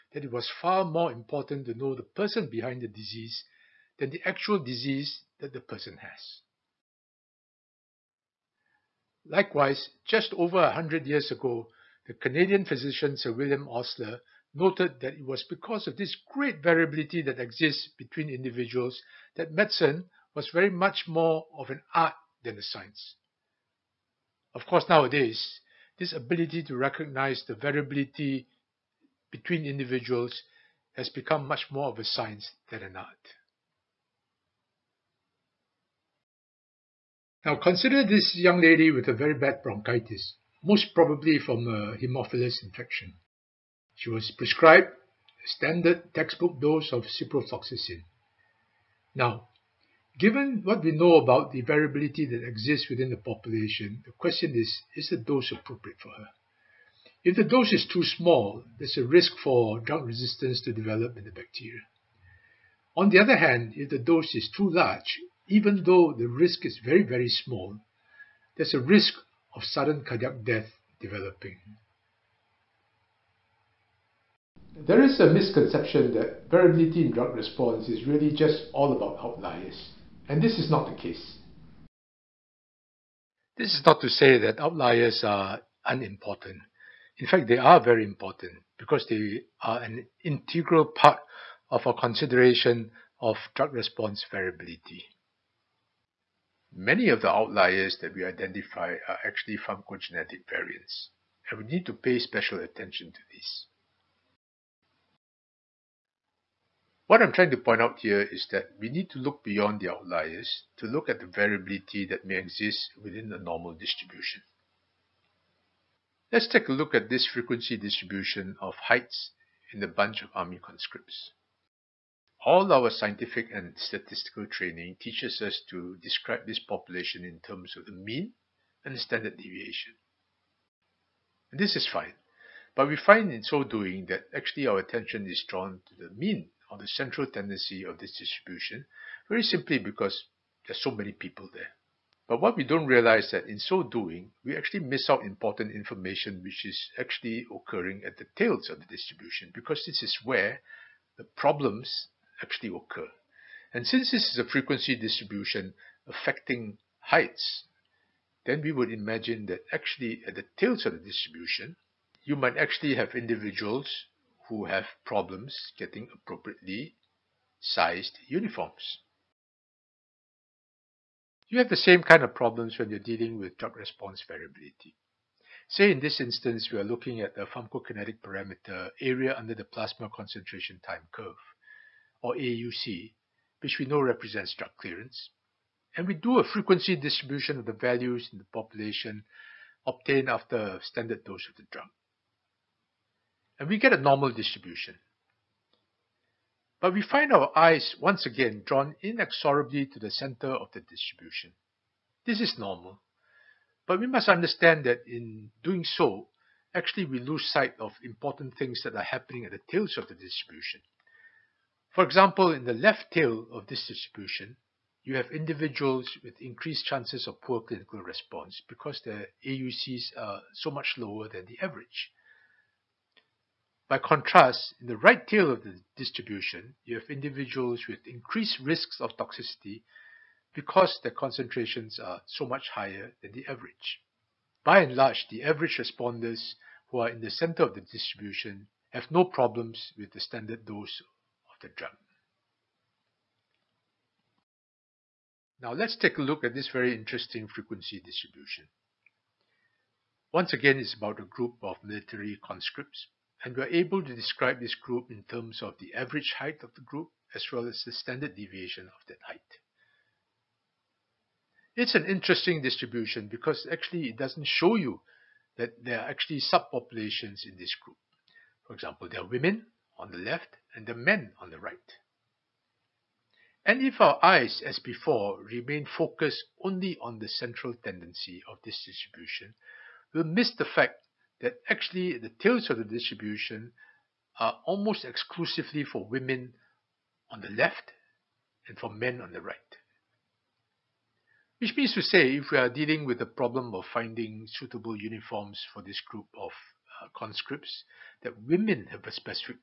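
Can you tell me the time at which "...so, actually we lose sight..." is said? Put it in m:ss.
3:25.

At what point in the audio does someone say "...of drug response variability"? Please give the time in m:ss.
1:33.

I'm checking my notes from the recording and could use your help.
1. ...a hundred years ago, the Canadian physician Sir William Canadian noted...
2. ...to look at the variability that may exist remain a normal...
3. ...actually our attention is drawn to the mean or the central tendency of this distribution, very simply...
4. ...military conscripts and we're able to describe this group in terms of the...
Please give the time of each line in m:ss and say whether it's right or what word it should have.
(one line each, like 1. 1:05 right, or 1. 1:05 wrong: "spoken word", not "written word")
1. 0:10 wrong: "Osler", not "Canadian"
2. 1:50 wrong: "within", not "remain"
3. 2:14 right
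4. 4:11 right.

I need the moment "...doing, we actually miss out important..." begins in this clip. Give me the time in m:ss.
2:23.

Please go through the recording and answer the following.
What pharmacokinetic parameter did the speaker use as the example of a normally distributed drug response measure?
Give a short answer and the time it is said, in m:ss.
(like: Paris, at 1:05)
area under the plasma concentration time curve, at 2:58.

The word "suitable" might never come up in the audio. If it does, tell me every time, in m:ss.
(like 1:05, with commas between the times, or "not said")
4:54.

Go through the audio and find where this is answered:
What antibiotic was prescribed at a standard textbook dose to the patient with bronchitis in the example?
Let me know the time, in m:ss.
0:47.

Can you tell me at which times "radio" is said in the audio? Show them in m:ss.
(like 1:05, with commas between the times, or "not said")
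not said.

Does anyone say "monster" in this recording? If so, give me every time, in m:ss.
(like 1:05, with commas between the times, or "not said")
not said.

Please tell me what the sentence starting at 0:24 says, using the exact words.
Of course, nowadays, this ability to recognize the variability between individuals has become much more of a science than an art.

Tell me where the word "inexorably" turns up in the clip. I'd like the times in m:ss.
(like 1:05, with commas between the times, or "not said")
3:19.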